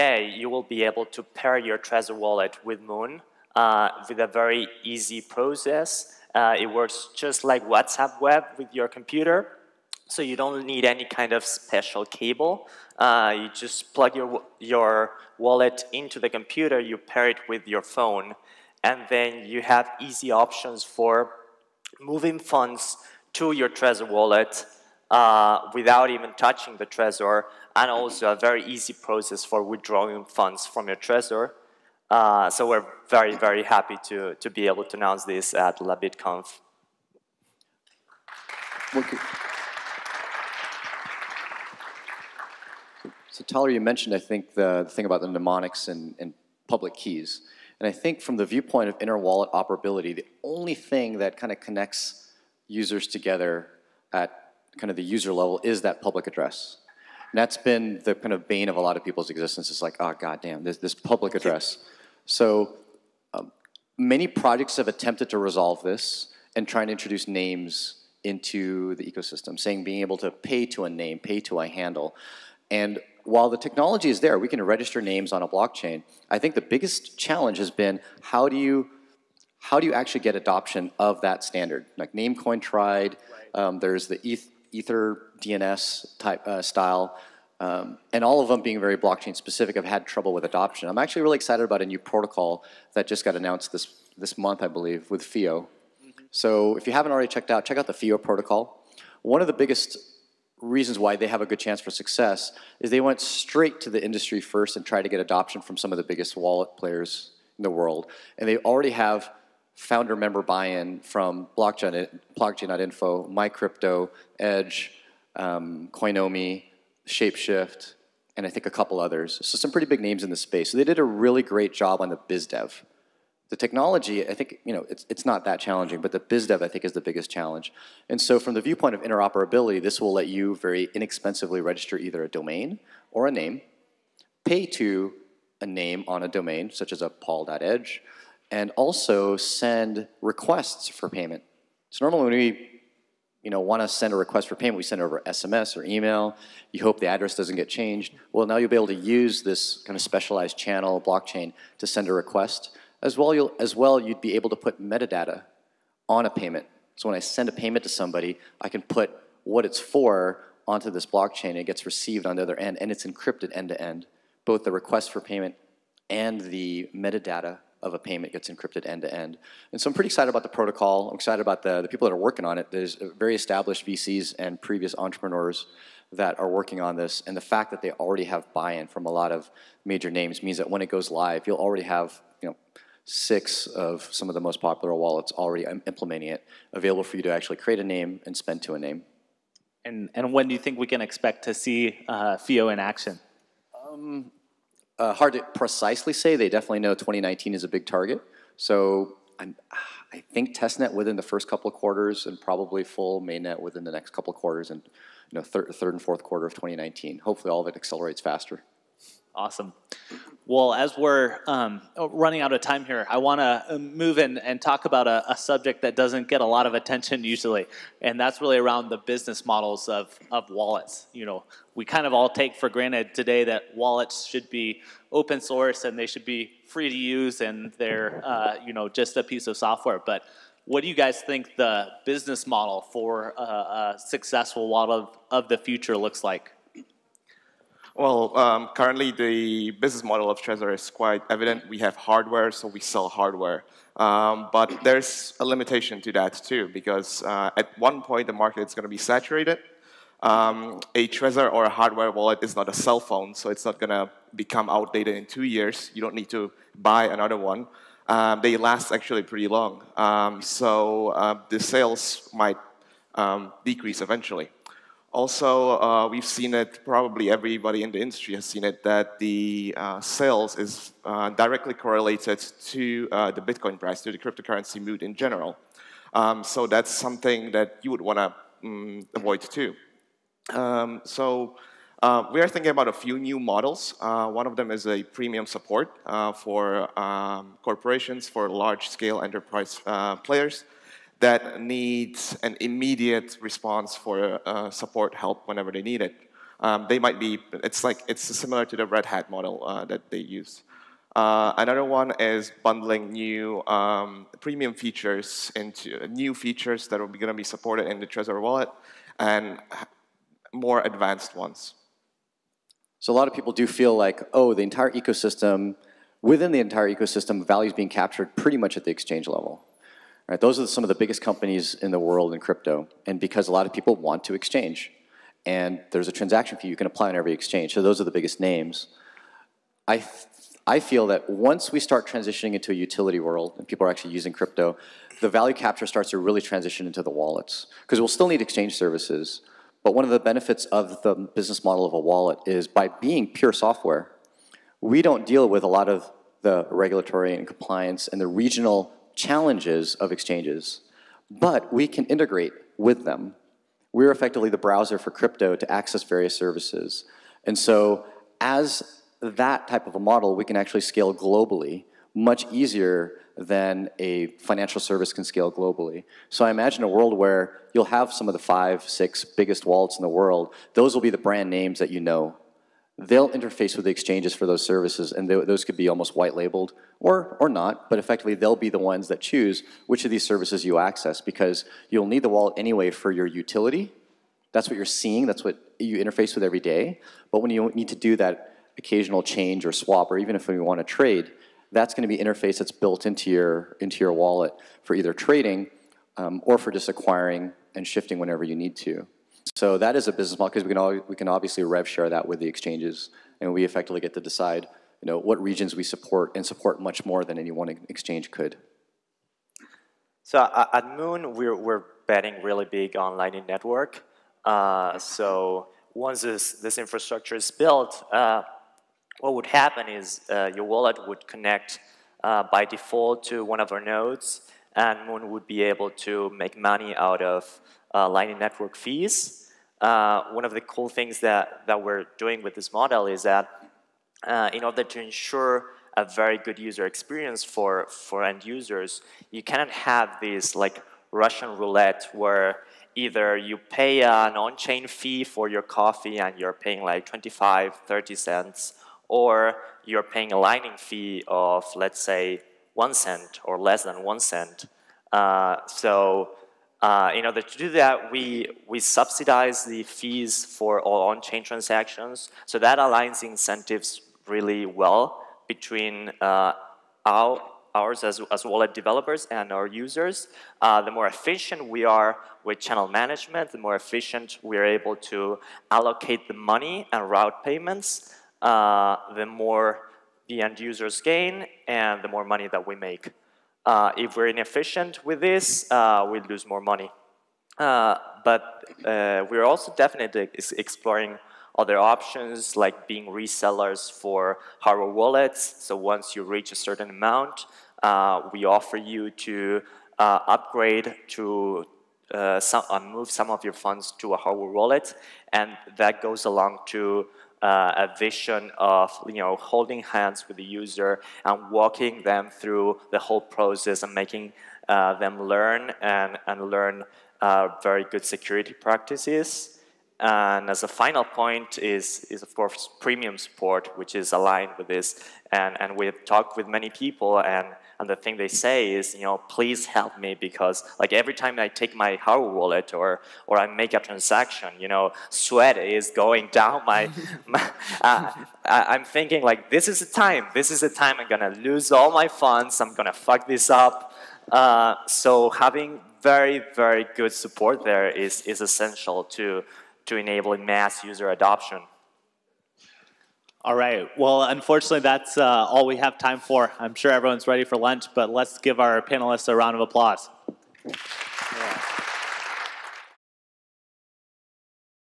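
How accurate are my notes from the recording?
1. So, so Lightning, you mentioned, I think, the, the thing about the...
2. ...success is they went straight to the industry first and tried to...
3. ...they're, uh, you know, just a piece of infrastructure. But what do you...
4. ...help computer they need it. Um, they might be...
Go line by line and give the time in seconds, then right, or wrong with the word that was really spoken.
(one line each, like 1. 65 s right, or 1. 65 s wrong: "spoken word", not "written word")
1. 43 s wrong: "Tyler", not "Lightning"
2. 101 s right
3. 227 s wrong: "software", not "infrastructure"
4. 295 s wrong: "whenever", not "computer".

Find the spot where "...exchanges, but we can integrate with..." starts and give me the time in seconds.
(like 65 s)
350 s.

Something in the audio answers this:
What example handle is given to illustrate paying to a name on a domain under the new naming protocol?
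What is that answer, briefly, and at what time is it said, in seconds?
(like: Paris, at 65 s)
paul.edge, at 137 s.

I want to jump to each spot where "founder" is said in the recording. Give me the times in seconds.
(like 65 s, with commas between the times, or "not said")
109 s.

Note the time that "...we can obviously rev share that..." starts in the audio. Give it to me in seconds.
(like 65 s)
401 s.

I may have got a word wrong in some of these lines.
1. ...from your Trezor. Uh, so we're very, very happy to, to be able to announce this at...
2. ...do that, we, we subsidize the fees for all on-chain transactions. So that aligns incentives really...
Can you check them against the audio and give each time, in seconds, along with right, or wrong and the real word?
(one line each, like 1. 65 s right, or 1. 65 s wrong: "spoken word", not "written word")
1. 30 s right
2. 457 s right.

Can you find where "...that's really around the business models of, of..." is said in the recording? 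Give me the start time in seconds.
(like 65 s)
218 s.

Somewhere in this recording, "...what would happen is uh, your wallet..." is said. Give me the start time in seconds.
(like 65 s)
419 s.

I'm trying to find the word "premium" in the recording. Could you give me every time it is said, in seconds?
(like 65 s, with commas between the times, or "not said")
285 s, 304 s, 522 s.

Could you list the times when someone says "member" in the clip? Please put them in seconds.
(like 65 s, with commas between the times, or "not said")
110 s.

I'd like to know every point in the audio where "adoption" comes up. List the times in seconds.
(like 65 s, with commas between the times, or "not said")
80 s, 90 s, 105 s, 551 s.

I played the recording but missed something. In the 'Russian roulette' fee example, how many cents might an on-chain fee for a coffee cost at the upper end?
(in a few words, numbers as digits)
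30 cents.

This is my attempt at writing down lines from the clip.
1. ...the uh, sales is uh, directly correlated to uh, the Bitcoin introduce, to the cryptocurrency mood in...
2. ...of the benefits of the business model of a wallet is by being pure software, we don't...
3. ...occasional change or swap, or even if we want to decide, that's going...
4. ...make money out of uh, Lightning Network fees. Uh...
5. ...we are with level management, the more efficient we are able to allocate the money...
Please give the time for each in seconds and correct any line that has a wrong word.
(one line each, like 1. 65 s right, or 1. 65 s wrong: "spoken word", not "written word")
1. 269 s wrong: "price", not "introduce"
2. 340 s right
3. 388 s wrong: "trade", not "decide"
4. 426 s right
5. 471 s wrong: "channel", not "level".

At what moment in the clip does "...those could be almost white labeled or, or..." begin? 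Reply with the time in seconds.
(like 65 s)
375 s.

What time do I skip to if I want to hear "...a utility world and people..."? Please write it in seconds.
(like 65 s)
332 s.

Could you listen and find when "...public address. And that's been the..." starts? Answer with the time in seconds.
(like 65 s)
56 s.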